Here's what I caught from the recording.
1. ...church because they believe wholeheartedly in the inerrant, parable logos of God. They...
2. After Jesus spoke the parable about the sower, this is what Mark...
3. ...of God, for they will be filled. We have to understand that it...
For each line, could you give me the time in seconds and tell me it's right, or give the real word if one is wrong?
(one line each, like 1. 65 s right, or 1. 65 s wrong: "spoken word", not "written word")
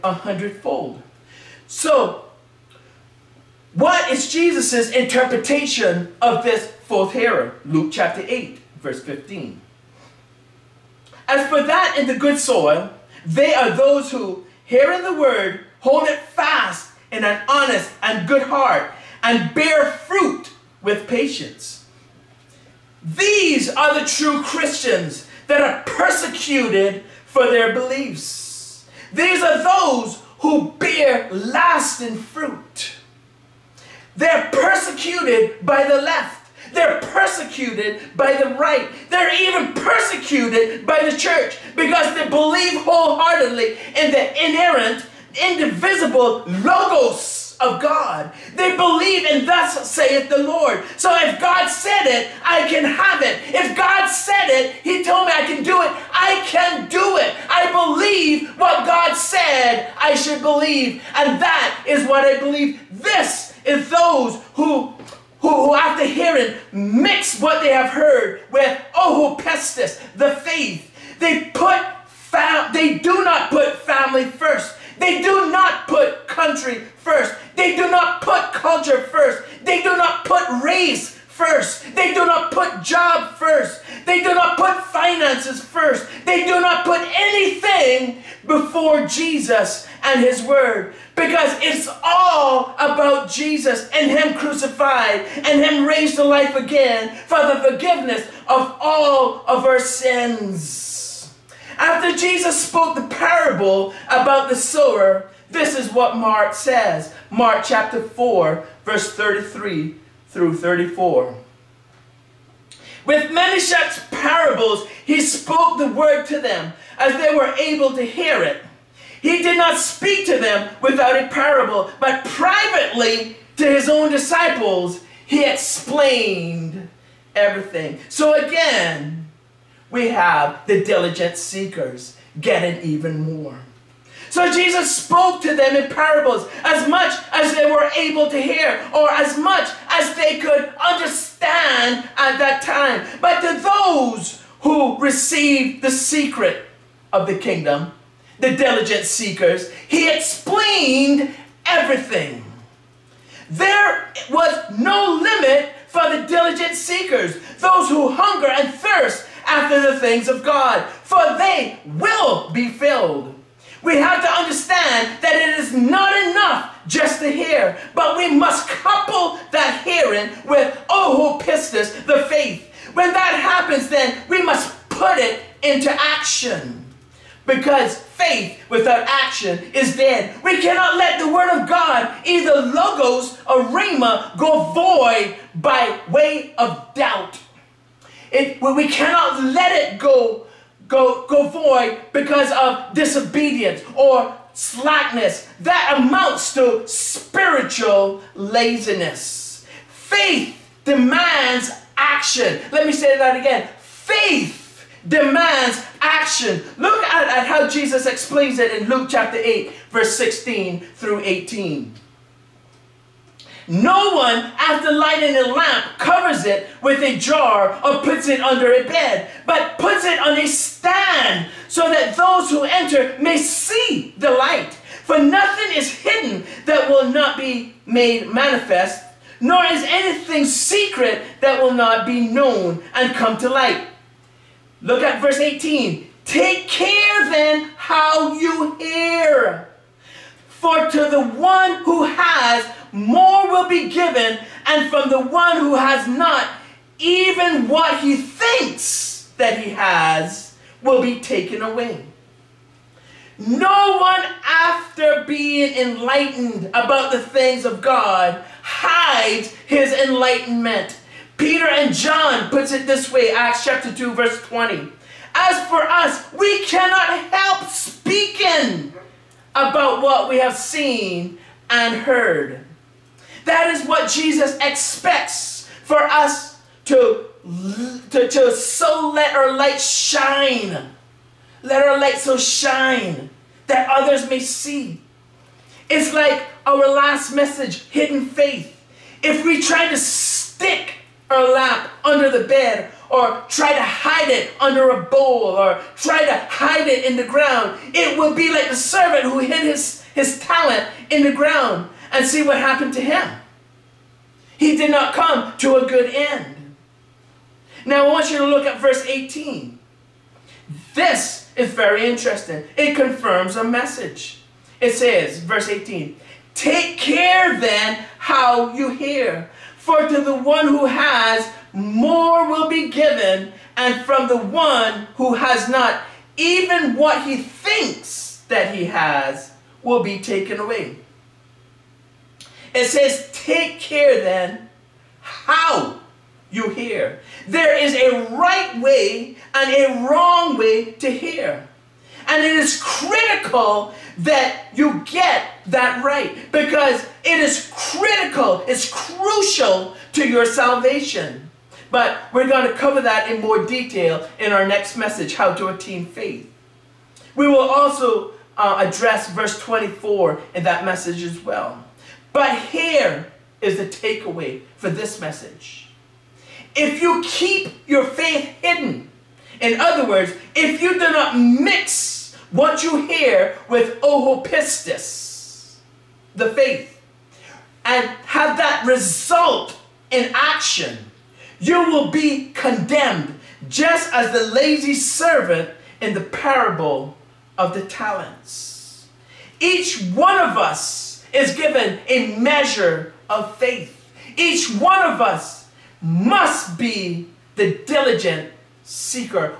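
1. 41 s wrong: "indivisible", not "parable"
2. 101 s right
3. 160 s right.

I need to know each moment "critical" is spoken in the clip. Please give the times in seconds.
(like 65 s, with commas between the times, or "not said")
342 s, 347 s.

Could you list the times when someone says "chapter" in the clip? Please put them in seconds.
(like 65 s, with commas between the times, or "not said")
7 s, 107 s, 209 s, 263 s.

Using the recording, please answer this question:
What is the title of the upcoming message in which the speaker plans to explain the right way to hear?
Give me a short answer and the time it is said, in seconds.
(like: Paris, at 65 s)
How to Attain Faith, at 355 s.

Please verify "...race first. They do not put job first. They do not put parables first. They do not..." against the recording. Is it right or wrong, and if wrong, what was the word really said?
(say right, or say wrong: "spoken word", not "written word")
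wrong: "finances", not "parables".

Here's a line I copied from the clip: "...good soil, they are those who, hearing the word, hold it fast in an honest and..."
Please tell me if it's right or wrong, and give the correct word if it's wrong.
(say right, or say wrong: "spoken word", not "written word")
right.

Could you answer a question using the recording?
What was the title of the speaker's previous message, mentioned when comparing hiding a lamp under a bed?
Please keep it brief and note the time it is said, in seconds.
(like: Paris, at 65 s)
Hidden Faith, at 287 s.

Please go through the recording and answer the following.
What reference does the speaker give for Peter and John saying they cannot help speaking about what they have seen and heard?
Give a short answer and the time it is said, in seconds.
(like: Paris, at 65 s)
Acts 2:20, at 263 s.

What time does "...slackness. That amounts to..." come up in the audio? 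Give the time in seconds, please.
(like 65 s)
194 s.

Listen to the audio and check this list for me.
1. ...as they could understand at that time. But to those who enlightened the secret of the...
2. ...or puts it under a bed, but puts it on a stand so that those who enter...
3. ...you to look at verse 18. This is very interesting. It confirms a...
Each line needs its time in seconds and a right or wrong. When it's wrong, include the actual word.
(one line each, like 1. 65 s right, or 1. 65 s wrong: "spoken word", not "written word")
1. 139 s wrong: "received", not "enlightened"
2. 217 s right
3. 308 s right.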